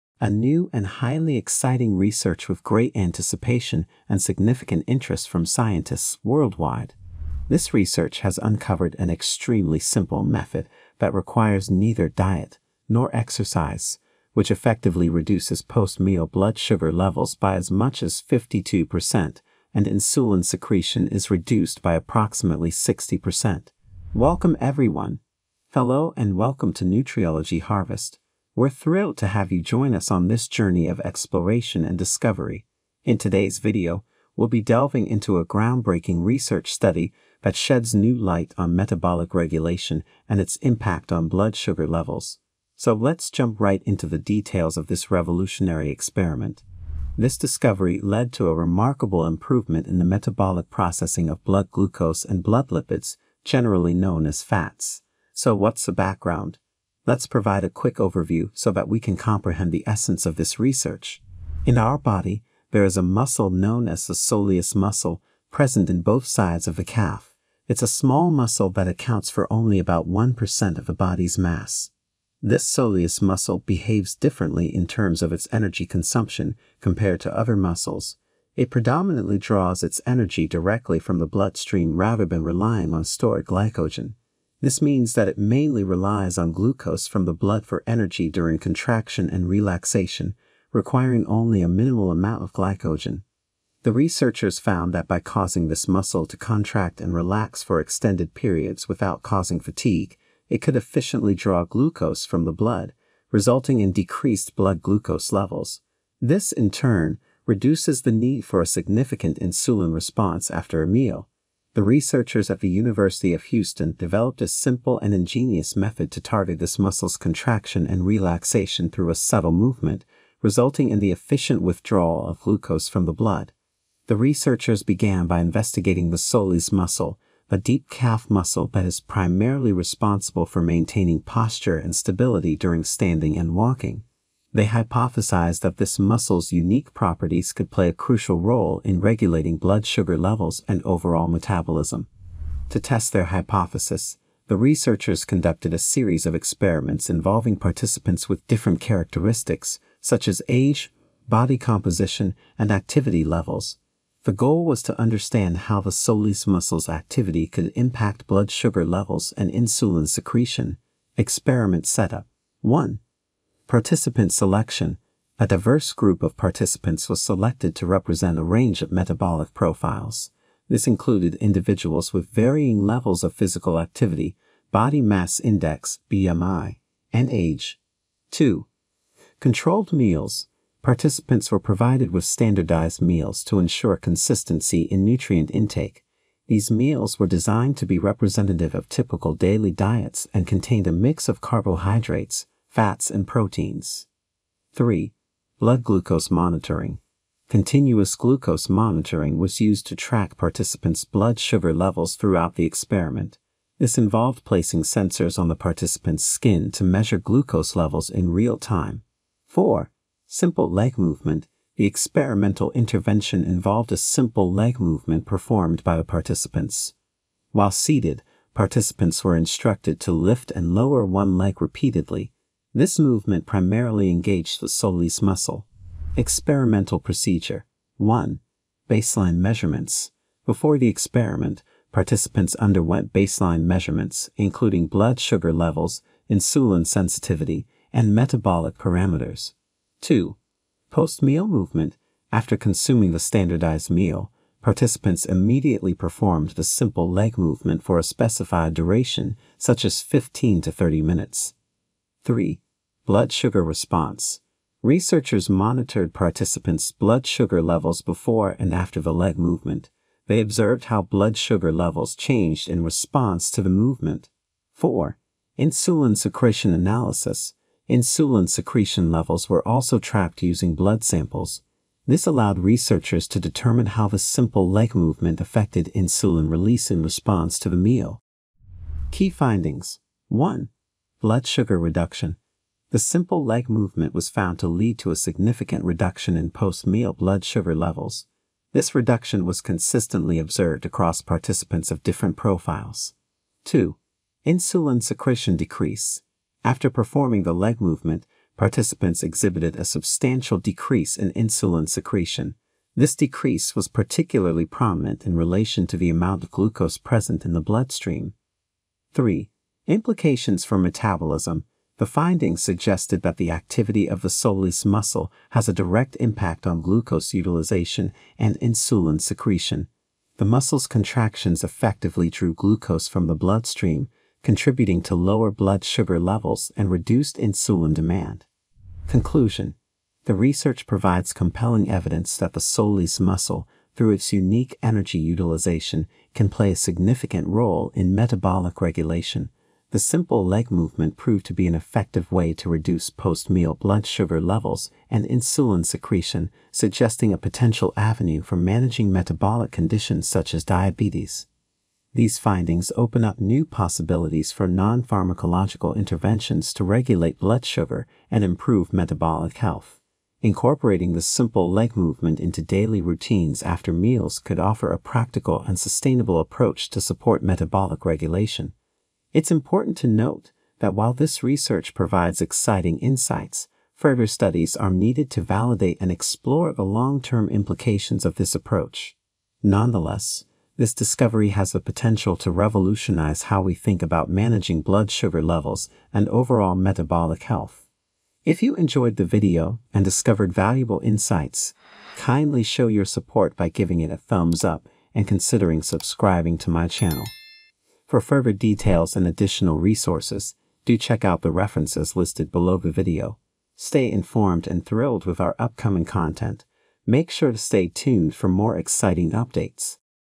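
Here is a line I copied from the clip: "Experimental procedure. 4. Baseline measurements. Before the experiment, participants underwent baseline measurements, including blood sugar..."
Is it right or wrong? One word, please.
wrong.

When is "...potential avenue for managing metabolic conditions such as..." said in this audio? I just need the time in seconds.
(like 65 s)
347 s.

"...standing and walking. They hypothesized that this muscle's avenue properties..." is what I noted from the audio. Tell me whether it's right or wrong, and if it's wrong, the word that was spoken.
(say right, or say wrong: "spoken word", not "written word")
wrong: "unique", not "avenue".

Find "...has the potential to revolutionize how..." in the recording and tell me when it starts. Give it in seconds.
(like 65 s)
381 s.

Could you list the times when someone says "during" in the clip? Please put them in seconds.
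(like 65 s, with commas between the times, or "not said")
88 s, 132 s.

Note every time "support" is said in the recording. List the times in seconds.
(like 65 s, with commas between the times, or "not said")
367 s, 393 s.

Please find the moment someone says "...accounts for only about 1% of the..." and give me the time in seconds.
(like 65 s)
68 s.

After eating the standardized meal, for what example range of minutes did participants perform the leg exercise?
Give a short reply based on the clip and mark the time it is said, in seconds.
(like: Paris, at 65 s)
15 to 30 minutes, at 250 s.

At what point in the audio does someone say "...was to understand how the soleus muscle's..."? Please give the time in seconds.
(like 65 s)
154 s.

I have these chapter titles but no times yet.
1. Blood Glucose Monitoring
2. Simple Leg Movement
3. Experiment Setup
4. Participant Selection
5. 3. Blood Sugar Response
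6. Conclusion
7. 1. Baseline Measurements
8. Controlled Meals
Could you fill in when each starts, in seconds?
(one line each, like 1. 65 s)
1. 195 s
2. 210 s
3. 143 s
4. 163 s
5. 253 s
6. 331 s
7. 229 s
8. 179 s.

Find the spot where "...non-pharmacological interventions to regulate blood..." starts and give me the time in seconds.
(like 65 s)
354 s.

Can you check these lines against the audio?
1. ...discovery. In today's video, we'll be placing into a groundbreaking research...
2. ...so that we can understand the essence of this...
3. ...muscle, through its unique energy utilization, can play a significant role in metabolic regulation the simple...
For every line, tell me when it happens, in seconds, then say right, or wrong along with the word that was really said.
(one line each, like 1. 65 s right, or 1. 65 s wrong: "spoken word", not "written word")
1. 31 s wrong: "delving", not "placing"
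2. 58 s wrong: "comprehend", not "understand"
3. 333 s right.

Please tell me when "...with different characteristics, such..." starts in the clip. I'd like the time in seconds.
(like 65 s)
148 s.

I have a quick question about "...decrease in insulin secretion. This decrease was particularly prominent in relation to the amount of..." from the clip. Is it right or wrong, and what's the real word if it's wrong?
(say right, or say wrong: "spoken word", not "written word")
right.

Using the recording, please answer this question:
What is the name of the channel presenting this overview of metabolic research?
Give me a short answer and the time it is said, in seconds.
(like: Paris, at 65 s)
Nutriology Harvest, at 26 s.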